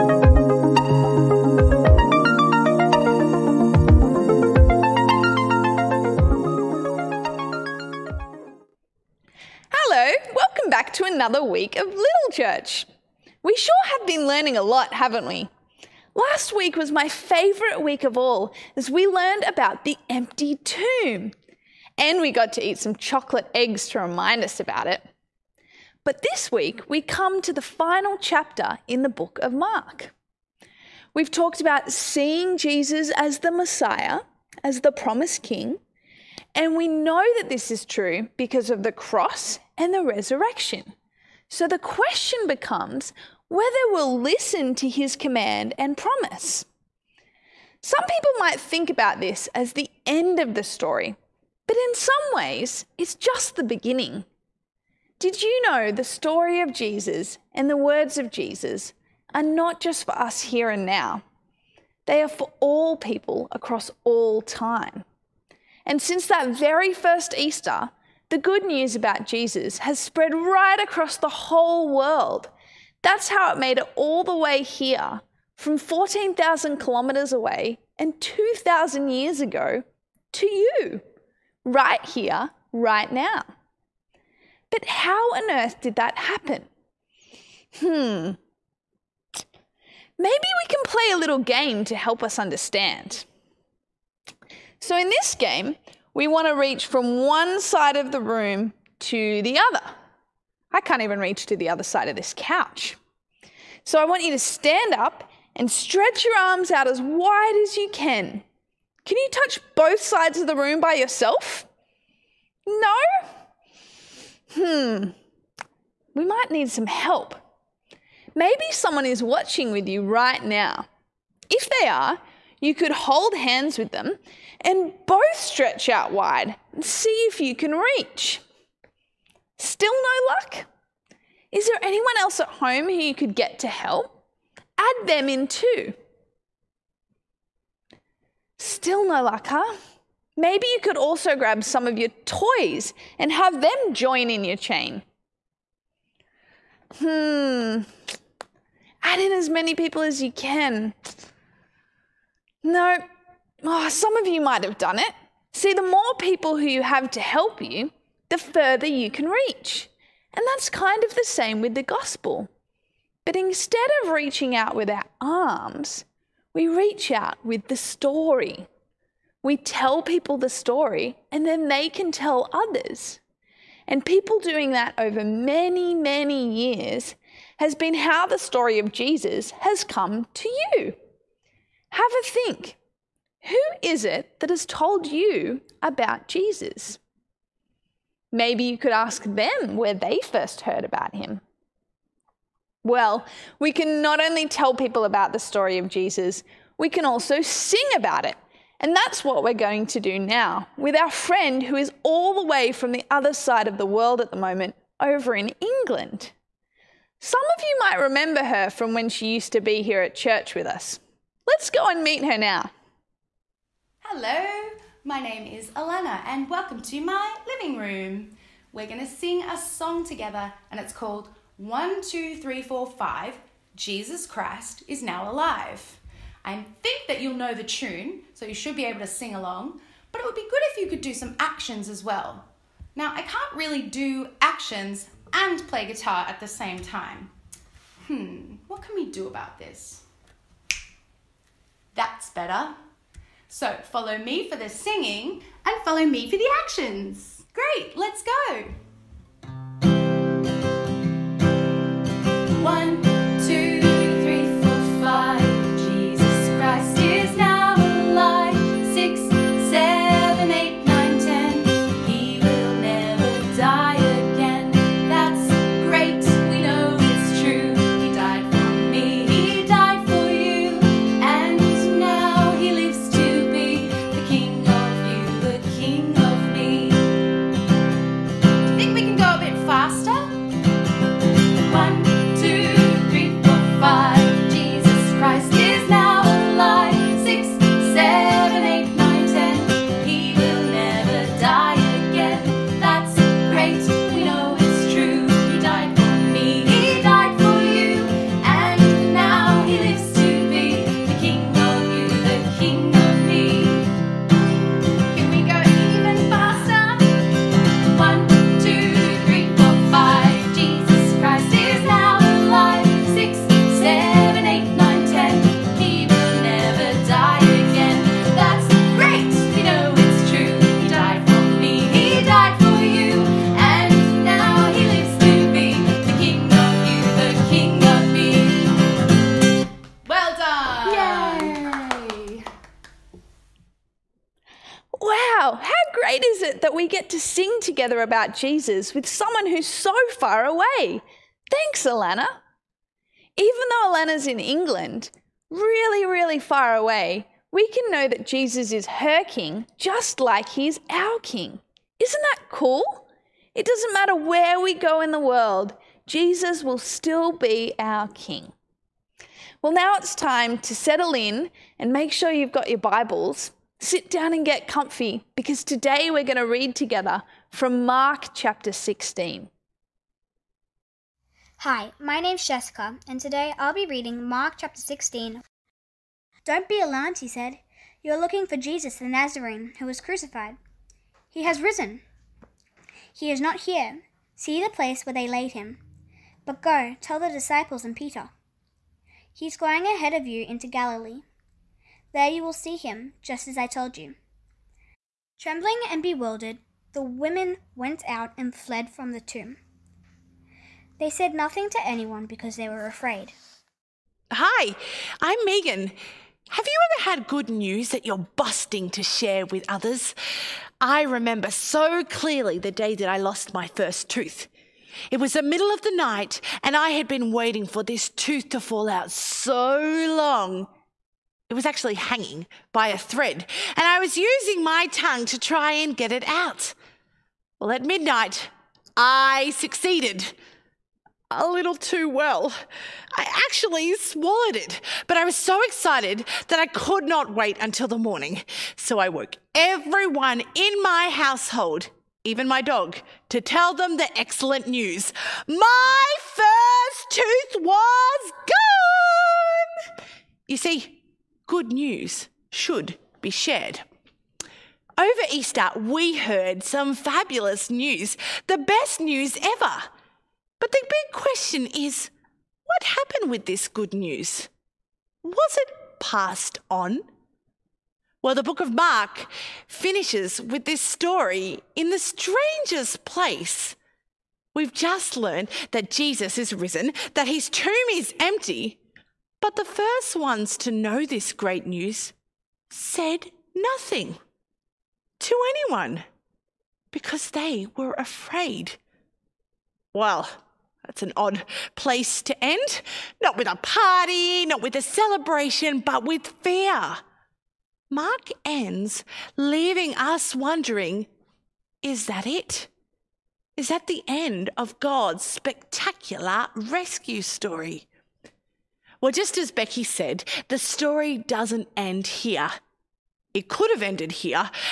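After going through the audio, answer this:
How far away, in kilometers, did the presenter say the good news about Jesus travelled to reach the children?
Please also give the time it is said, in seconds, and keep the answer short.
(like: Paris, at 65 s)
14,000 kilometers, at 75 s.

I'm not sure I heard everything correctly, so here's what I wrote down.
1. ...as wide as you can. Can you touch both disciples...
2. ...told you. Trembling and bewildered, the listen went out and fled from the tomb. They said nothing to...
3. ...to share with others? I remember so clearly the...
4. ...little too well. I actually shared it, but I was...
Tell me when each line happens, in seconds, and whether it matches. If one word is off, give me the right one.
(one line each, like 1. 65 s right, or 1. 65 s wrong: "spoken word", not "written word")
1. 106 s wrong: "sides", not "disciples"
2. 393 s wrong: "women", not "listen"
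3. 408 s right
4. 431 s wrong: "swallowed", not "shared".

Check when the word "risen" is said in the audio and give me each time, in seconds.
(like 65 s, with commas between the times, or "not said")
381 s, 476 s.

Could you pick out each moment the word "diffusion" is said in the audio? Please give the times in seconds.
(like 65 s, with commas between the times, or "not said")
not said.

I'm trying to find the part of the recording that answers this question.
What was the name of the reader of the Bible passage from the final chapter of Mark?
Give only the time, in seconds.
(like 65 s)
372 s.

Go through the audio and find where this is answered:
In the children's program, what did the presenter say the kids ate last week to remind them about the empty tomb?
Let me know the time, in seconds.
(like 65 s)
22 s.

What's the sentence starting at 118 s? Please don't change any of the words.
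Maybe someone is watching with you right now.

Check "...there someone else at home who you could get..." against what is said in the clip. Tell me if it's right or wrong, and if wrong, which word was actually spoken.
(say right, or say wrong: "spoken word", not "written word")
wrong: "anyone", not "someone".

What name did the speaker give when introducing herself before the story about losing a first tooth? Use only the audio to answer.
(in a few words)
Megan.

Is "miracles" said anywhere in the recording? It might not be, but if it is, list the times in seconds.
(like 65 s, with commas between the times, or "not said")
not said.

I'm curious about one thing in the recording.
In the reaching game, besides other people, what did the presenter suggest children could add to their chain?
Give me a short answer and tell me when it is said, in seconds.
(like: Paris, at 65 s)
Toys, at 142 s.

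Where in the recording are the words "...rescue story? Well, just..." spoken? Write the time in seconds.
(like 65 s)
506 s.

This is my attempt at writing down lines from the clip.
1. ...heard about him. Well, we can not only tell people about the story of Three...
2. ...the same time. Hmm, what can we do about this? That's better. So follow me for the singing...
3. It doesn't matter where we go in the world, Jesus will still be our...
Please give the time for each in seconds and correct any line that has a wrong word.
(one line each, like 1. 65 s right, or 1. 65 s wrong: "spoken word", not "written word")
1. 190 s wrong: "Jesus", not "Three"
2. 236 s right
3. 353 s right.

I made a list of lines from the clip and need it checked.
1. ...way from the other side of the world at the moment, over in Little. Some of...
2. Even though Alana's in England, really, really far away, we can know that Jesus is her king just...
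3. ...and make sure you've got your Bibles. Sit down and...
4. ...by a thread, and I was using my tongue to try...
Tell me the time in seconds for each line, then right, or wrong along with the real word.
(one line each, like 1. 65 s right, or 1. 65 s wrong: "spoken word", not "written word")
1. 202 s wrong: "England", not "Little"
2. 343 s right
3. 361 s right
4. 422 s right.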